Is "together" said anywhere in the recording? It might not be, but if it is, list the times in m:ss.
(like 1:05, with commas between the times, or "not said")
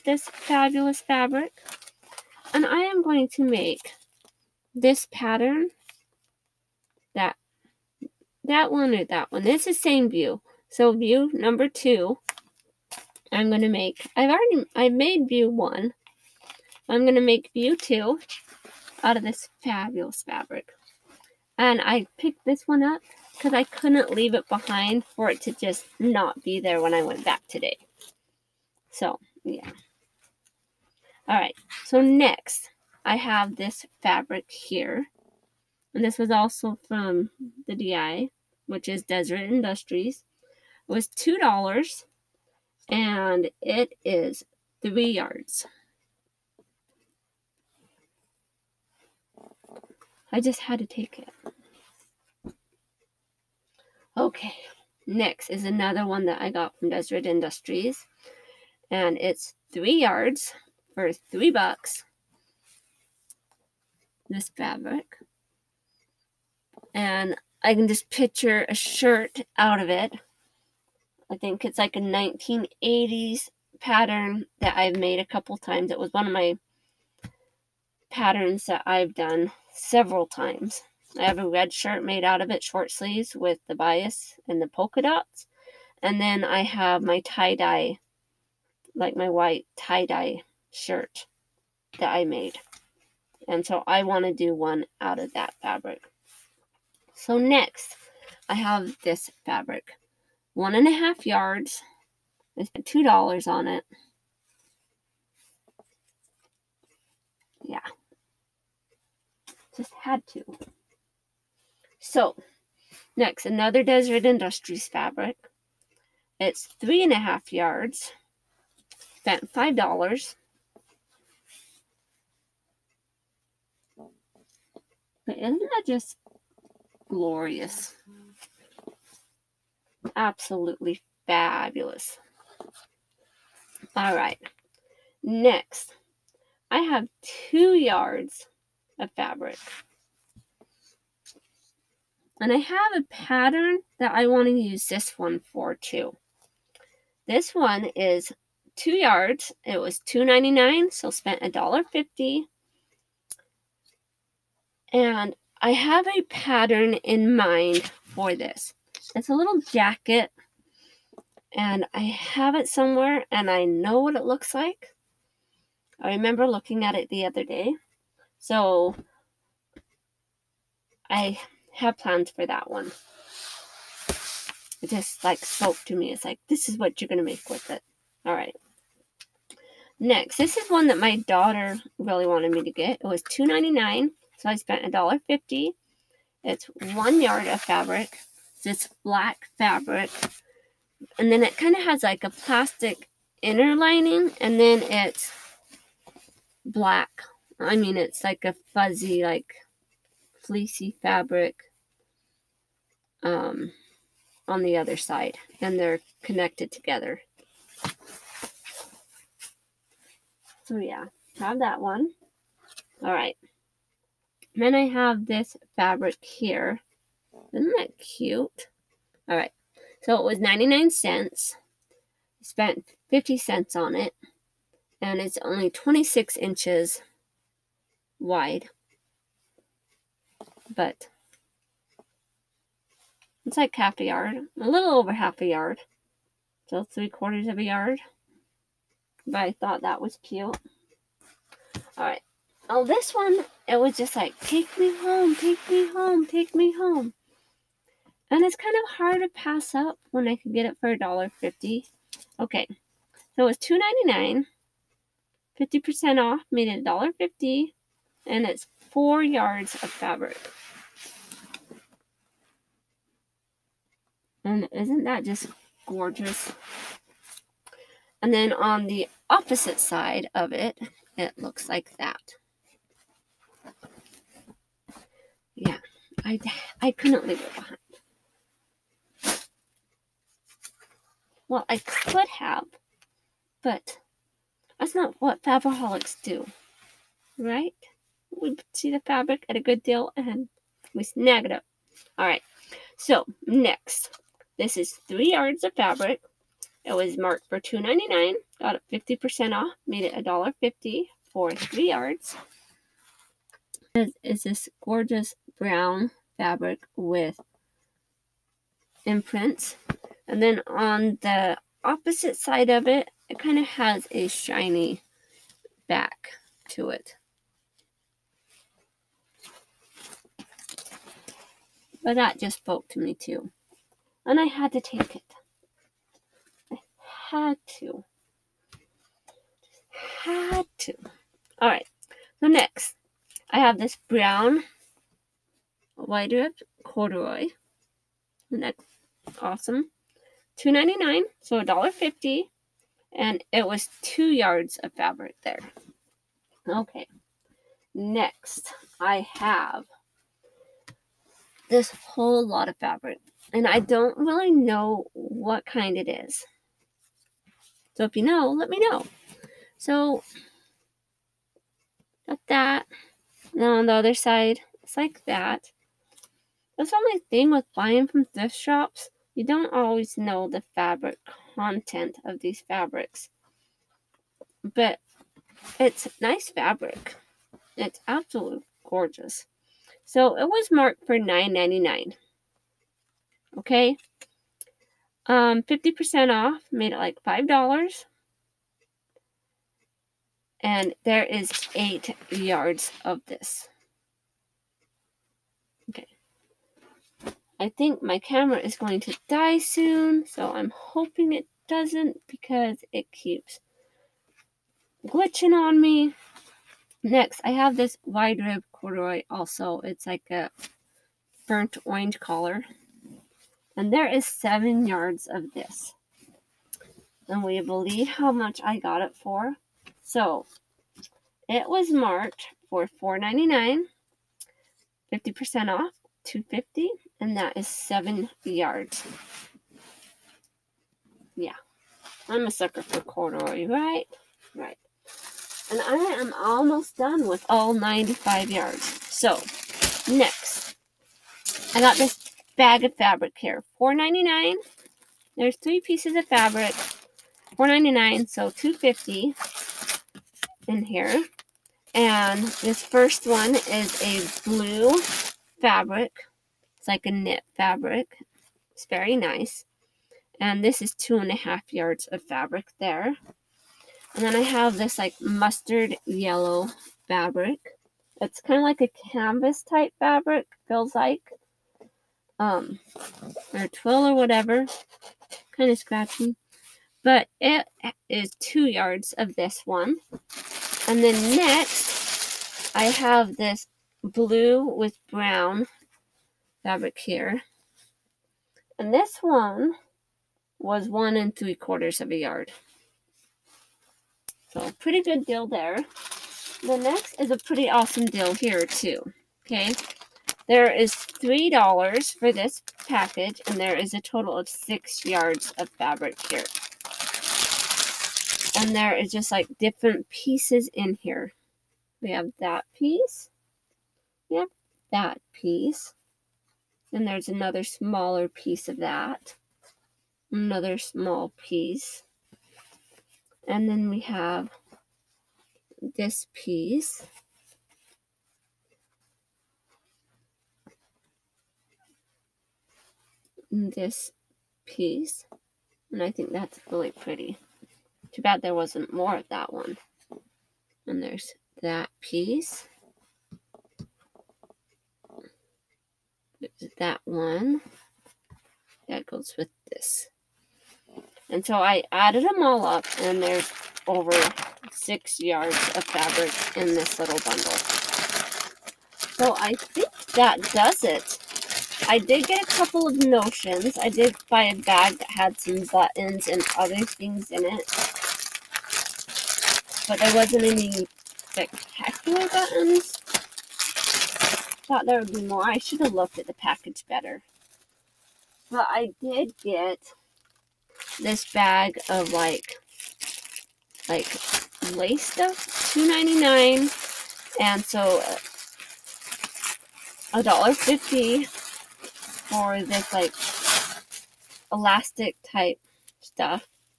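3:26.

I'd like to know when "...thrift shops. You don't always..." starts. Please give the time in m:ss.
6:08.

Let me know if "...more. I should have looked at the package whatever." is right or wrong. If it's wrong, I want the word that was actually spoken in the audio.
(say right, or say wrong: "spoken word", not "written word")
wrong: "better", not "whatever".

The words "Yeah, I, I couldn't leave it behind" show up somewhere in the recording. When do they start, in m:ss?
4:35.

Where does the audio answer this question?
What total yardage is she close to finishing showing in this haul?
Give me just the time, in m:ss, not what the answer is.
7:17.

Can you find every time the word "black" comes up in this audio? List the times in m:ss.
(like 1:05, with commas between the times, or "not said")
3:09, 3:16.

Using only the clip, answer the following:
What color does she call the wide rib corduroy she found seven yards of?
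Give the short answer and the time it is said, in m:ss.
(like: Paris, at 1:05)
Burnt orange, at 6:51.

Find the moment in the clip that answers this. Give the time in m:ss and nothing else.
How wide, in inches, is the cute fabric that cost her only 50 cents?
3:45.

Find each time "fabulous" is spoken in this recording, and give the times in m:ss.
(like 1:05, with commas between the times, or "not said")
0:00, 0:19, 2:11.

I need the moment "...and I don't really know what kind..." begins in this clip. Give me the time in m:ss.
5:53.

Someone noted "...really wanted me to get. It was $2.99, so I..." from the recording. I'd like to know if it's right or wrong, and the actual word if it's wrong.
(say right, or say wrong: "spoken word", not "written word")
right.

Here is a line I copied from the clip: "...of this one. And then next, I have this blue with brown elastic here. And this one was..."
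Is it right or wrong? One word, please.
wrong.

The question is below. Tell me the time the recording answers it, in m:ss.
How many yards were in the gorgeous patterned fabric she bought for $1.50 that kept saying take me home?
4:18.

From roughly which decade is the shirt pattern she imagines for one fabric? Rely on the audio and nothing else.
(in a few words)
1980s.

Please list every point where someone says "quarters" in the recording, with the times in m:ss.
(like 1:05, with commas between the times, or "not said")
3:57, 8:11.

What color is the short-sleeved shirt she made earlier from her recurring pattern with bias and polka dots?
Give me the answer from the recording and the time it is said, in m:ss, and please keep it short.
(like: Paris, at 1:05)
Red, at 1:21.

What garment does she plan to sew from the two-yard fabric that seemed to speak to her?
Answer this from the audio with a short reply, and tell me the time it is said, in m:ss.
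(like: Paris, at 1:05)
A little jacket, at 2:39.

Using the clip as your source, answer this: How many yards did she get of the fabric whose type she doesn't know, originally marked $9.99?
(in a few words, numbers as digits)
8.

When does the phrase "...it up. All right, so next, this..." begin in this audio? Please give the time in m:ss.
4:51.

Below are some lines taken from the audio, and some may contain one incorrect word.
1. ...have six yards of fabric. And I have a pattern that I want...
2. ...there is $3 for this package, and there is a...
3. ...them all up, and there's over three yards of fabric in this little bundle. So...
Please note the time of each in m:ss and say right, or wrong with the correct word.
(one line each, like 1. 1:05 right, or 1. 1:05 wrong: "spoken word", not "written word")
1. 2:16 wrong: "two", not "six"
2. 8:20 right
3. 9:12 wrong: "six", not "three".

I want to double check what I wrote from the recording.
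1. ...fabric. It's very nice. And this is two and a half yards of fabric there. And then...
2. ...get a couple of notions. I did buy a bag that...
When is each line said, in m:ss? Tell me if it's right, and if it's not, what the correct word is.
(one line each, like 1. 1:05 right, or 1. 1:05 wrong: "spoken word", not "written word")
1. 7:37 right
2. 9:22 right.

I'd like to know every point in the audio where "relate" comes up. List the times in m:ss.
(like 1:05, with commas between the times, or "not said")
not said.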